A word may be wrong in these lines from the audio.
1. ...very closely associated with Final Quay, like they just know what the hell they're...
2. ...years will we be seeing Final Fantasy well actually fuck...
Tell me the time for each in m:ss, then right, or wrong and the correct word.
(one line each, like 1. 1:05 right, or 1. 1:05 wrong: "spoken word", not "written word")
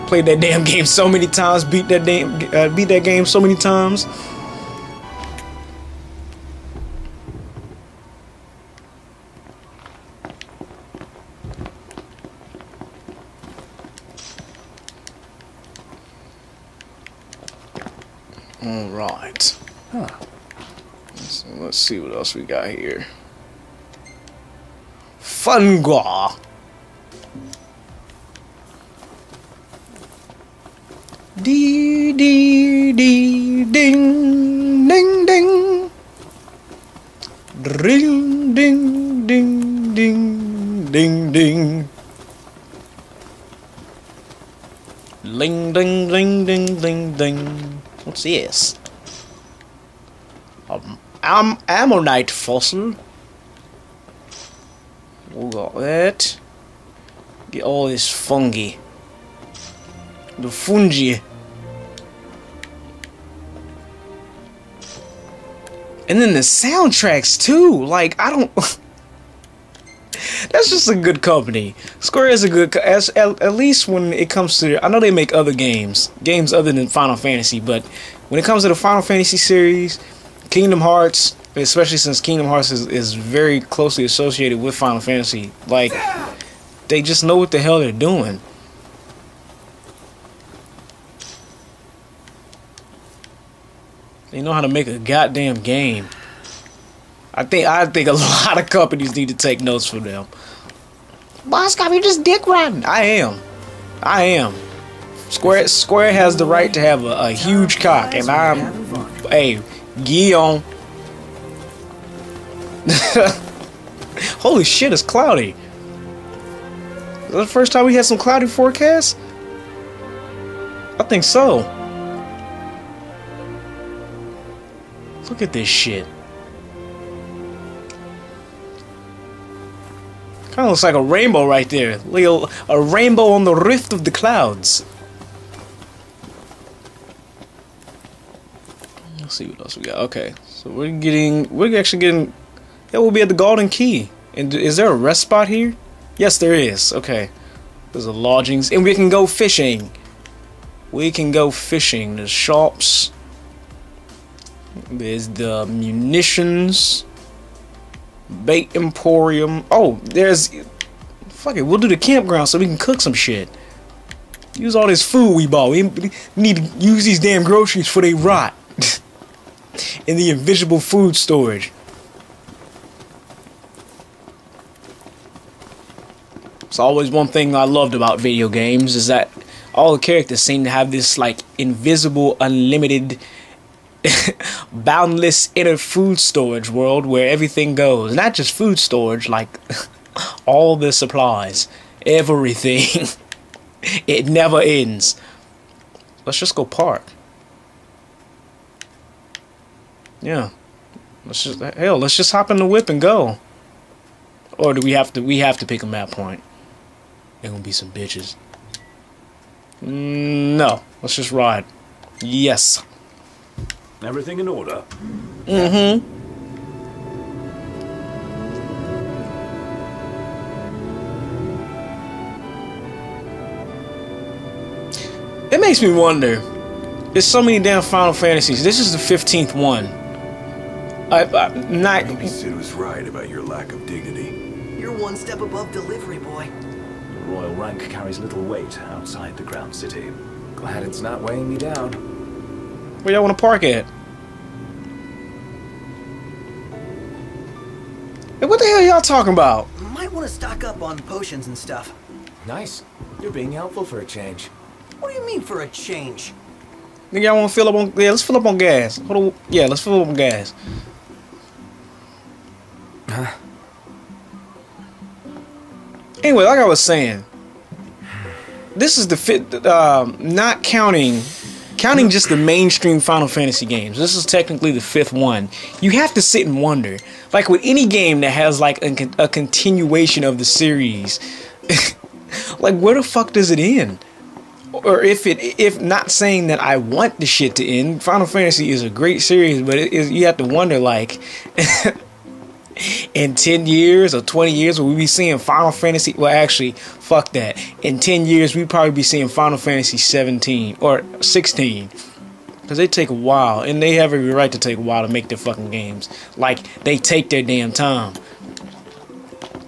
1. 1:23 wrong: "Fantasy", not "Quay"
2. 4:54 right.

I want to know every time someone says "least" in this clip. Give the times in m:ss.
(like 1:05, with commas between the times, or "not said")
1:13.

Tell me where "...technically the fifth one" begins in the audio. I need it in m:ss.
4:34.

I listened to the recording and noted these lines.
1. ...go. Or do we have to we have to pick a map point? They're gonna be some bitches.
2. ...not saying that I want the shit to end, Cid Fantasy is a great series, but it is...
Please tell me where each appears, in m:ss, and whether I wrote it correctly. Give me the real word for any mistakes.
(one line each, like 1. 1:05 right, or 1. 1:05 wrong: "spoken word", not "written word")
1. 3:22 right
2. 4:45 wrong: "Final", not "Cid".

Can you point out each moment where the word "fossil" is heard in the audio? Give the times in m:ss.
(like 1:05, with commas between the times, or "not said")
0:52.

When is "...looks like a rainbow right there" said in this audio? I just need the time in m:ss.
2:10.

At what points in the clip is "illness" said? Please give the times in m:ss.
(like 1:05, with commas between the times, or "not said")
not said.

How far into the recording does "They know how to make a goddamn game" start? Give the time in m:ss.
1:34.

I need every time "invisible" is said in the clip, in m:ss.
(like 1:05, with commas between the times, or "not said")
2:50, 3:01.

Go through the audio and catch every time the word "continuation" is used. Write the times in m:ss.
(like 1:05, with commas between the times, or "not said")
4:39.